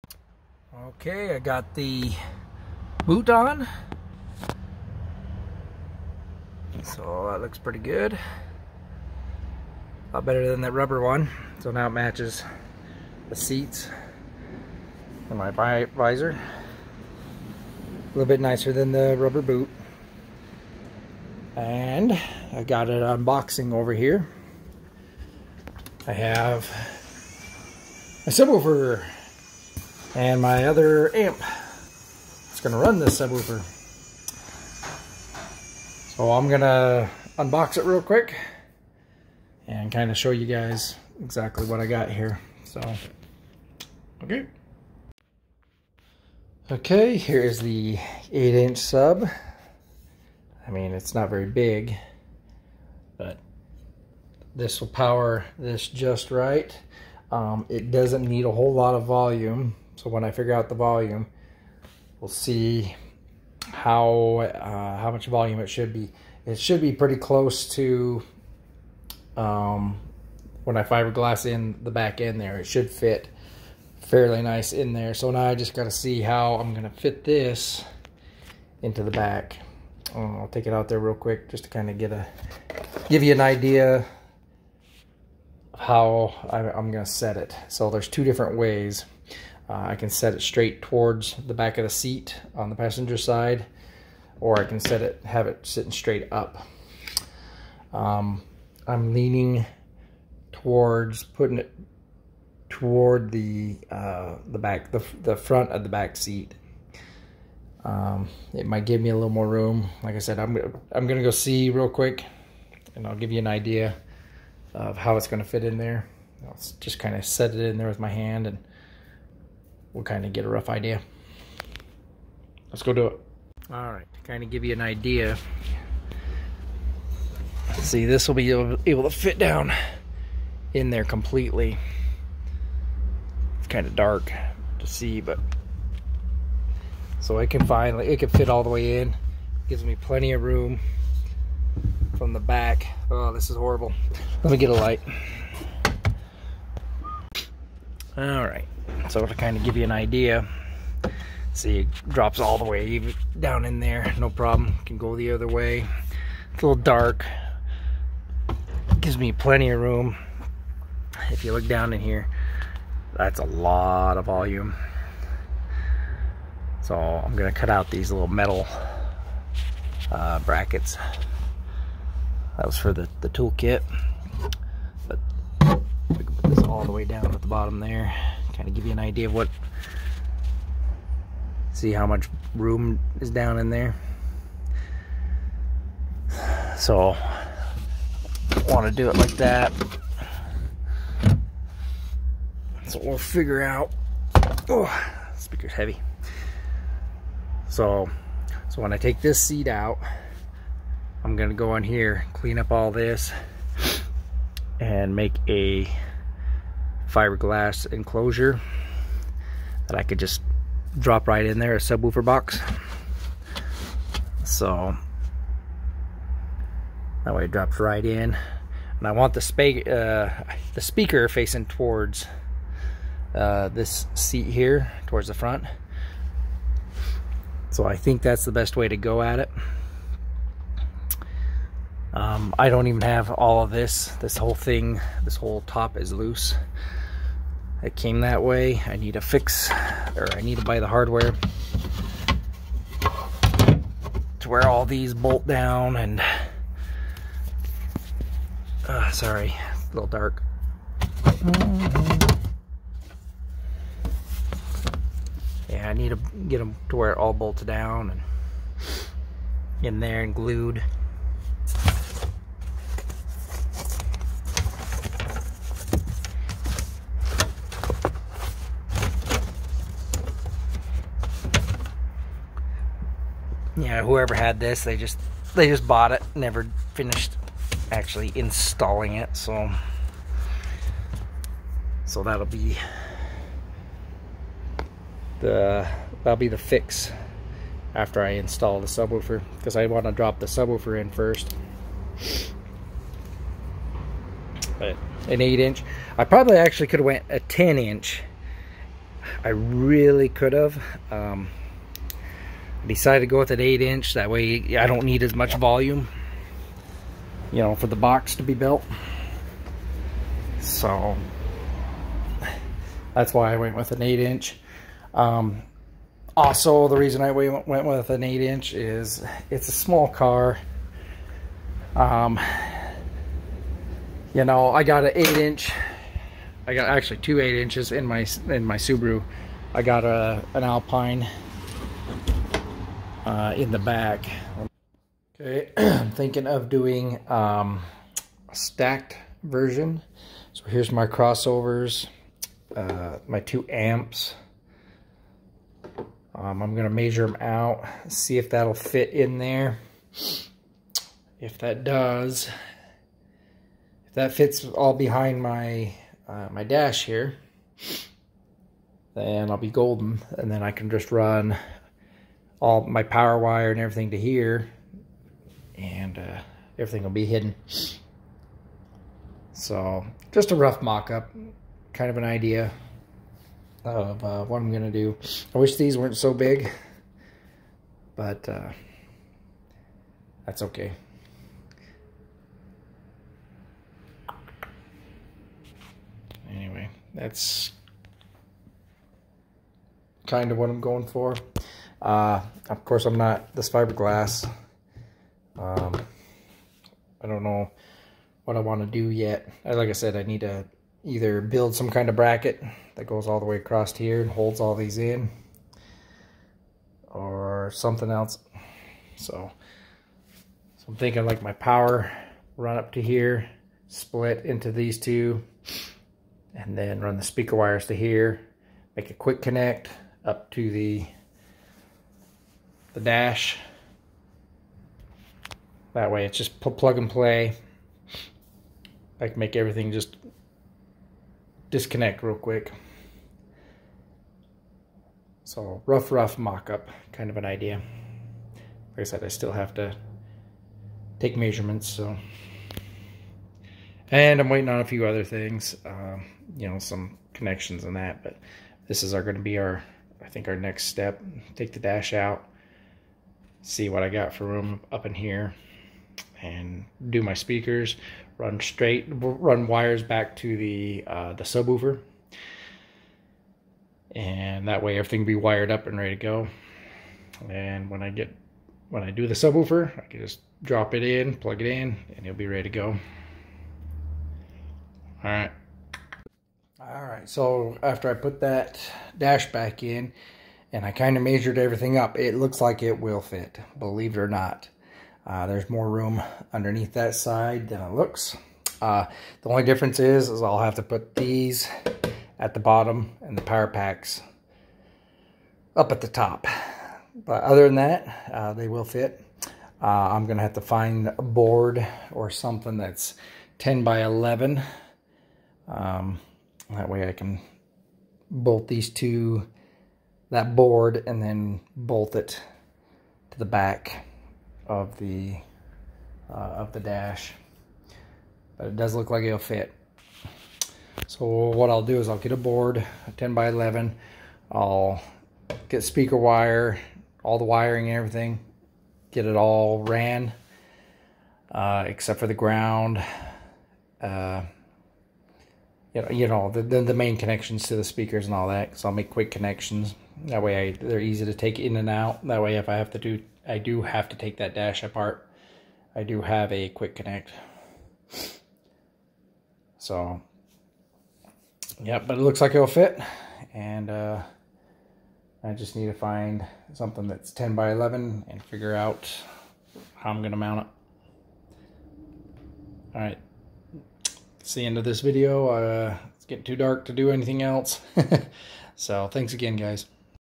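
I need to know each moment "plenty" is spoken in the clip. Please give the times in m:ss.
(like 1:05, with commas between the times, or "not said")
2:19, 2:39.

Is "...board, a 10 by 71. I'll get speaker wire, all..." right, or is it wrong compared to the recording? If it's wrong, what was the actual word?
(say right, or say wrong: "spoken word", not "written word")
wrong: "11", not "71".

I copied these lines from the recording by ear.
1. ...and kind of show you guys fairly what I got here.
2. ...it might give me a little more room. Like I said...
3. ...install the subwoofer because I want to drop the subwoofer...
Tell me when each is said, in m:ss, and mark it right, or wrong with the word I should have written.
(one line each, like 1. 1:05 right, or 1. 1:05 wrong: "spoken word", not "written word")
1. 0:39 wrong: "exactly", not "fairly"
2. 1:48 right
3. 4:48 right.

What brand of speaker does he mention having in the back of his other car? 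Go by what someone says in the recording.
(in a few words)
Alpine.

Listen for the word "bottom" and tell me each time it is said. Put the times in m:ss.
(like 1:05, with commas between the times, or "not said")
2:57, 8:12.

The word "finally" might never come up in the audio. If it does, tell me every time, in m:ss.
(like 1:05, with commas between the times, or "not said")
2:17.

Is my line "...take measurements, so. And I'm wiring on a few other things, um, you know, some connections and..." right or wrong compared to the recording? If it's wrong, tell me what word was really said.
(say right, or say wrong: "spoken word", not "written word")
wrong: "waiting", not "wiring".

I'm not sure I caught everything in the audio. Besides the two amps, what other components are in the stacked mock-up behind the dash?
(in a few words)
Crossovers.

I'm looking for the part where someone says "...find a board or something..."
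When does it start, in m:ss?
8:20.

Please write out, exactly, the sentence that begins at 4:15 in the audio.
Yeah, I need to get them to where it all bolts down and in there and glued.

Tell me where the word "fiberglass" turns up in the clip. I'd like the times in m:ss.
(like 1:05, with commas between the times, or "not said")
1:10, 3:27, 6:33.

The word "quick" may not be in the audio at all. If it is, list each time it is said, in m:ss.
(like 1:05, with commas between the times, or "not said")
0:38, 1:21, 1:51, 6:59, 7:12, 8:59, 9:06.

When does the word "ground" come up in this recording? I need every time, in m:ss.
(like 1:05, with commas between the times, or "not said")
8:52.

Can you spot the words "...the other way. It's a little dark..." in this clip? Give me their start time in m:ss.
2:35.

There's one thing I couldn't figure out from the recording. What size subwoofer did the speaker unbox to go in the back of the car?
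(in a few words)
8-inch.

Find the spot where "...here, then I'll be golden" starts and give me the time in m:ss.
5:57.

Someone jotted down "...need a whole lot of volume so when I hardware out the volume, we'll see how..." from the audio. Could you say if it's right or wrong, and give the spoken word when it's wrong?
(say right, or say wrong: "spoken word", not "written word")
wrong: "figure", not "hardware".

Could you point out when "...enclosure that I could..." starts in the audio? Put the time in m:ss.
3:27.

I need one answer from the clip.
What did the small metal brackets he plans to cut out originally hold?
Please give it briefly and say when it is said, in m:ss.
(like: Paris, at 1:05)
The toolkit, at 2:53.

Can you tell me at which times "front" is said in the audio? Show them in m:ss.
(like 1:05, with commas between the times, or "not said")
1:45, 3:45.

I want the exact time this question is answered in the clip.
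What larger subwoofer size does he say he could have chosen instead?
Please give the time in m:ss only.
4:57.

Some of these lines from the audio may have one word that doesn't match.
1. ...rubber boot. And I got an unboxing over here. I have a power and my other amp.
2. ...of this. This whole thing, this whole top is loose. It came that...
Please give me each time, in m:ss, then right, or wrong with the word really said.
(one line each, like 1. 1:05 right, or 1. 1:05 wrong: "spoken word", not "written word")
1. 0:19 wrong: "subwoofer", not "power"
2. 3:53 right.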